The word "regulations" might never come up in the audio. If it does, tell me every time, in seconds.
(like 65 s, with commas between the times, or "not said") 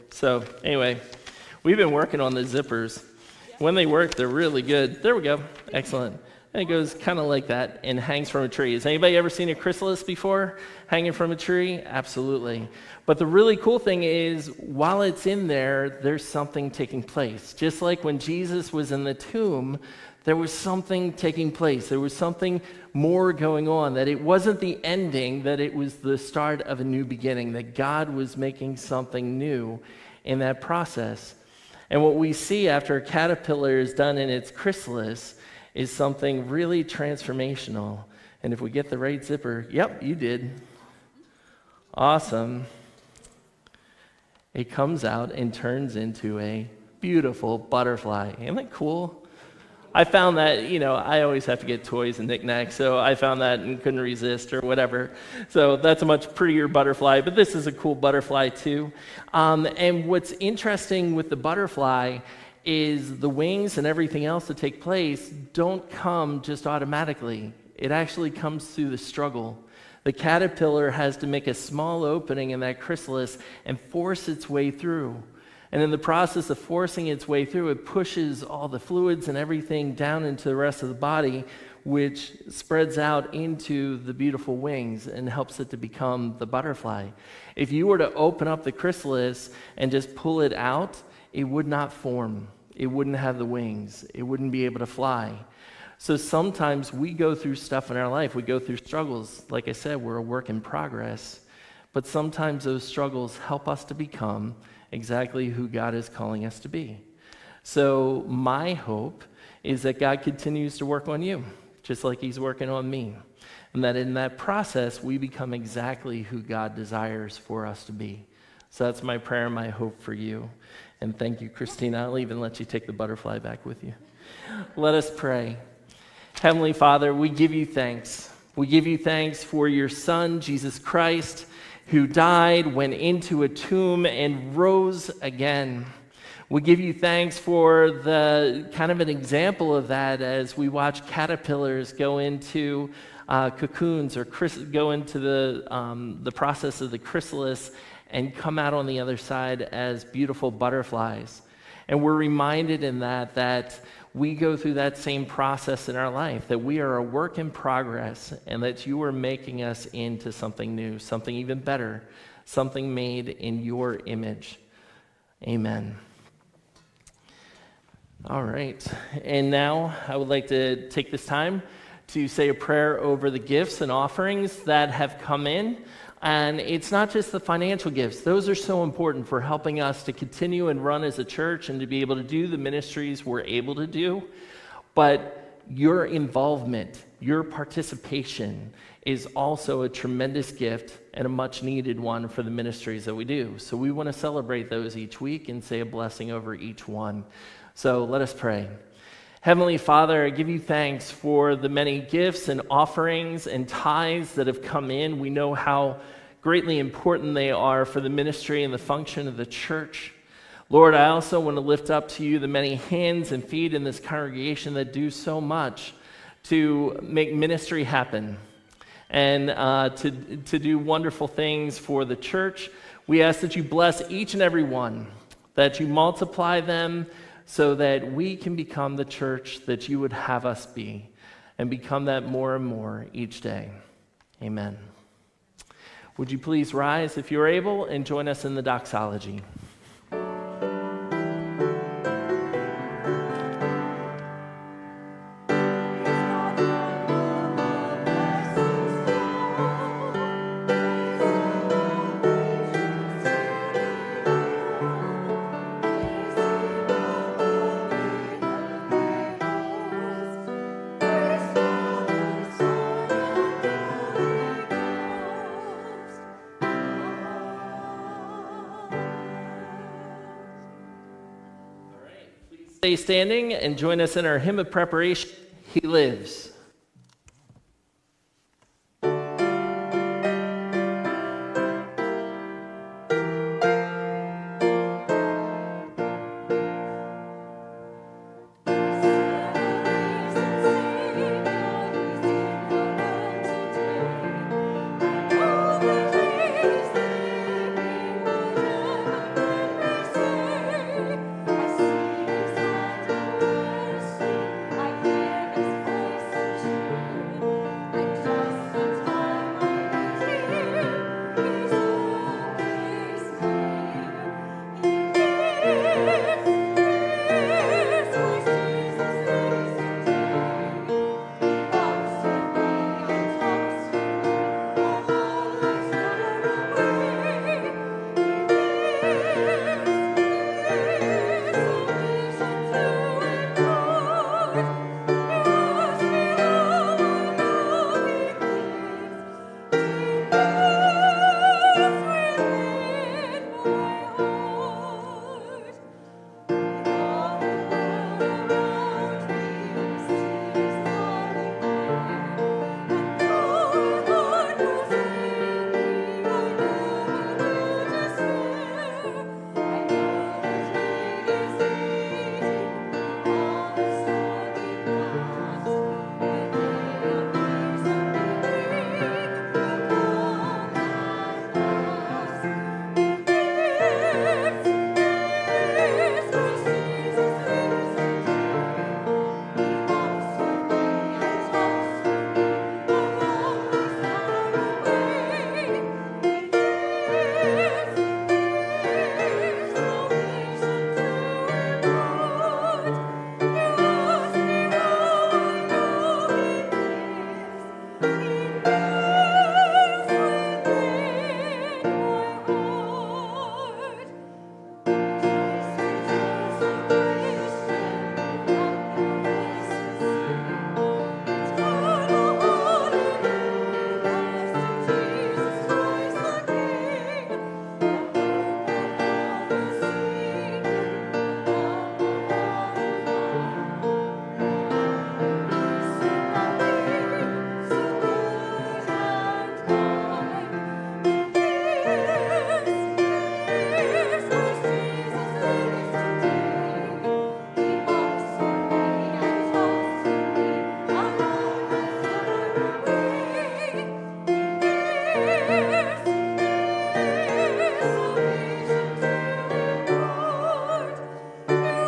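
not said.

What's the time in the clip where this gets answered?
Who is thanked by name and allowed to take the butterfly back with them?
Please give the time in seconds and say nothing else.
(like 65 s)
121 s.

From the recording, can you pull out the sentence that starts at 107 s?
So, my hope is that God continues to work on you, just like He's working on me.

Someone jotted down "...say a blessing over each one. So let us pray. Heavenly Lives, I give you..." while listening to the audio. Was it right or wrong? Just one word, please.
wrong.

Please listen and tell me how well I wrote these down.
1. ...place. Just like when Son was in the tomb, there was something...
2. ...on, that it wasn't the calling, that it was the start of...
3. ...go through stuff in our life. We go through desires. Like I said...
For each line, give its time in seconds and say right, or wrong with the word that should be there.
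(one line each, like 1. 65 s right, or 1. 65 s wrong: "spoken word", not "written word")
1. 17 s wrong: "Jesus", not "Son"
2. 23 s wrong: "ending", not "calling"
3. 97 s wrong: "struggles", not "desires".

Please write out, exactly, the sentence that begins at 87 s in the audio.
If you were to open up the chrysalis and just pull it out, it would not form.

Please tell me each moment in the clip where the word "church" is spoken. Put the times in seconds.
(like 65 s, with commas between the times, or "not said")
181 s, 209 s, 222 s, 229 s.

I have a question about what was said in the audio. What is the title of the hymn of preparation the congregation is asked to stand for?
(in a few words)
He Lives.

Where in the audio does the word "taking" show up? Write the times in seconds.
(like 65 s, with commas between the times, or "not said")
16 s, 21 s.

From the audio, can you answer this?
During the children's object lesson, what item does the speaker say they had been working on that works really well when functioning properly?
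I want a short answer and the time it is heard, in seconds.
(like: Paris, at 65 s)
Zippers, at 2 s.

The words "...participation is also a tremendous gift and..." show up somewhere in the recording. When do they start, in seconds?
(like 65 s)
187 s.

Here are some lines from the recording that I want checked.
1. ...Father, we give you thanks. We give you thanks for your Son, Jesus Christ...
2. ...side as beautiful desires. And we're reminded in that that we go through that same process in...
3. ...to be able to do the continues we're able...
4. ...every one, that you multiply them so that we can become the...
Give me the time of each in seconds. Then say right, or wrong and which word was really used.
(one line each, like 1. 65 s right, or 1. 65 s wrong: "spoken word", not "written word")
1. 126 s right
2. 149 s wrong: "butterflies", not "desires"
3. 181 s wrong: "ministries", not "continues"
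4. 224 s right.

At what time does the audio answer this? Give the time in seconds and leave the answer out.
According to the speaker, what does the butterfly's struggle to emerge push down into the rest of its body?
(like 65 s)
78 s.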